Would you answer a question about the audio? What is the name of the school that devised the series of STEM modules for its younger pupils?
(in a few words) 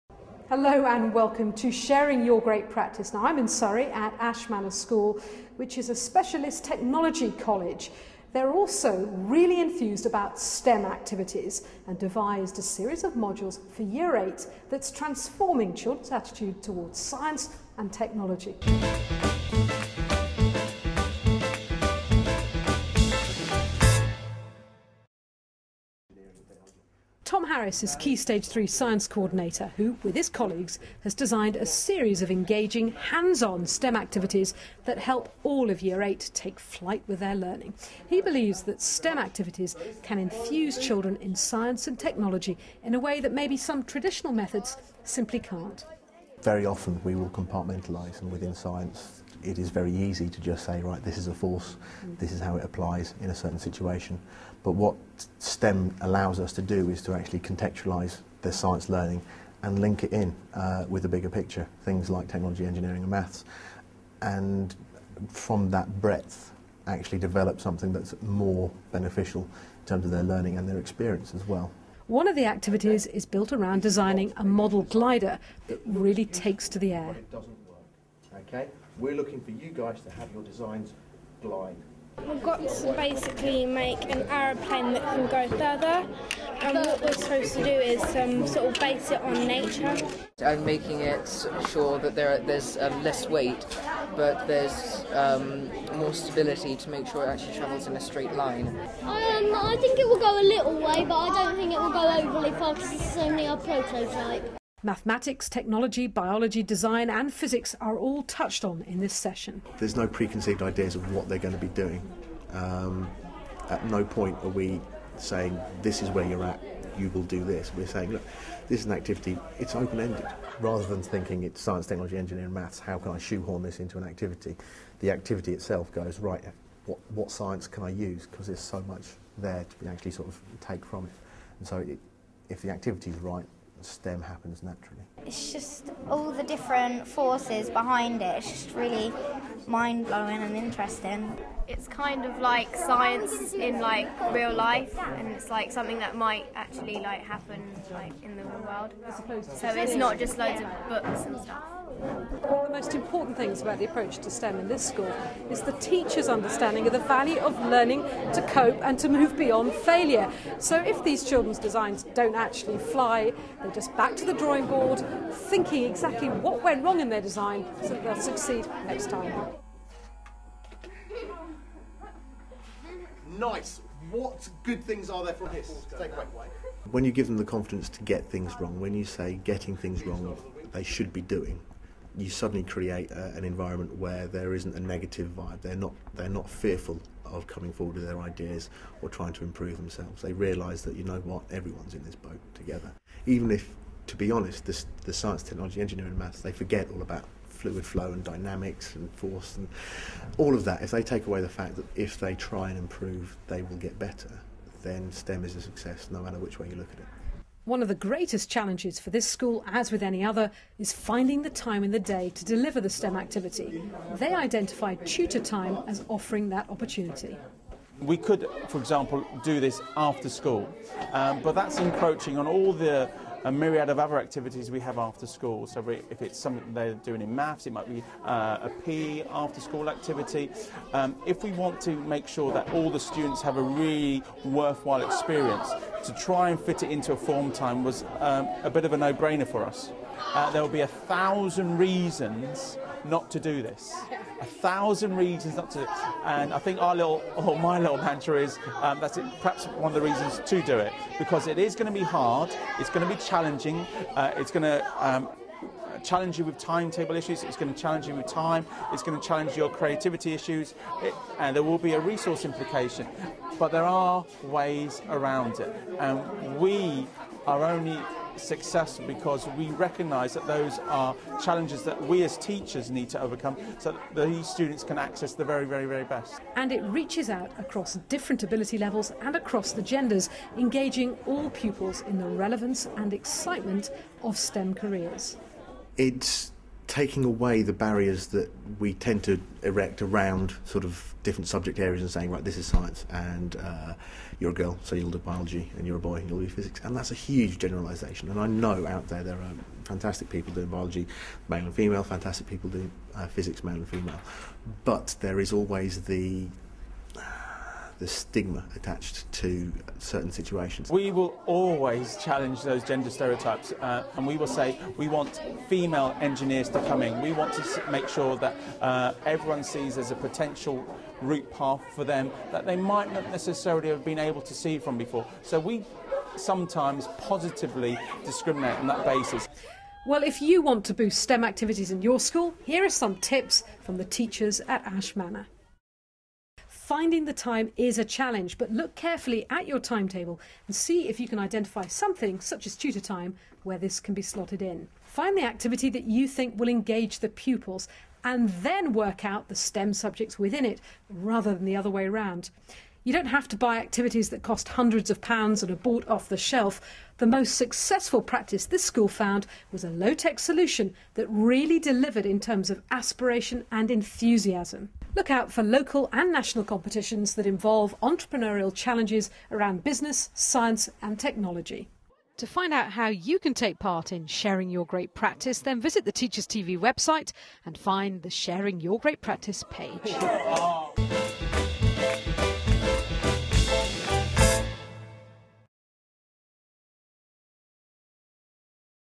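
Ash Manor School.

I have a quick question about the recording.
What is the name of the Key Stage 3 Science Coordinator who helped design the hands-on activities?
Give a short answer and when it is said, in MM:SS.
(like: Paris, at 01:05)
Tom Harris, at 00:27.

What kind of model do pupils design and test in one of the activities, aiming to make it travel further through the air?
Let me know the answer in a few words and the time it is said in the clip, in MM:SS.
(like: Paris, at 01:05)
glider, at 01:14.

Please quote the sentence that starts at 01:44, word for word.
Mathematics, technology, biology, design and physics are all touched on in this session.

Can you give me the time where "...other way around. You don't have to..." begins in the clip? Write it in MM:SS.
05:51.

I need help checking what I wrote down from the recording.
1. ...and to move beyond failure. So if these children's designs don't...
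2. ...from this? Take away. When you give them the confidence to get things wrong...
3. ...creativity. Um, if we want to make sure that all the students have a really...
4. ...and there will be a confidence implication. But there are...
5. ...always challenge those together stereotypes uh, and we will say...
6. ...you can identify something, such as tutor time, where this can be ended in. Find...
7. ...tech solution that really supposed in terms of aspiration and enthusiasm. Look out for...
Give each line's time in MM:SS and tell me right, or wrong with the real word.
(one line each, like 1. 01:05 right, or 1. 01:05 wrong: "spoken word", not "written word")
1. 02:38 right
2. 02:55 right
3. 03:49 wrong: "activity", not "creativity"
4. 04:21 wrong: "resource", not "confidence"
5. 05:11 wrong: "gender", not "together"
6. 05:41 wrong: "slotted", not "ended"
7. 06:00 wrong: "delivered", not "supposed".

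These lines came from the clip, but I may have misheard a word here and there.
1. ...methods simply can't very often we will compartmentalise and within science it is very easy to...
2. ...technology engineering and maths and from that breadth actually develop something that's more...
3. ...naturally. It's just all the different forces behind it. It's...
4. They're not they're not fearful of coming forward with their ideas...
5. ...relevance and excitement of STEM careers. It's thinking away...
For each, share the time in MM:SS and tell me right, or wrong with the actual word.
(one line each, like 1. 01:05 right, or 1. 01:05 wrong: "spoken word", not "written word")
1. 00:44 right
2. 01:02 right
3. 02:14 right
4. 03:05 right
5. 04:42 wrong: "taking", not "thinking".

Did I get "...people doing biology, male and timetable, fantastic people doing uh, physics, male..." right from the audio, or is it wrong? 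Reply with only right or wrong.
wrong.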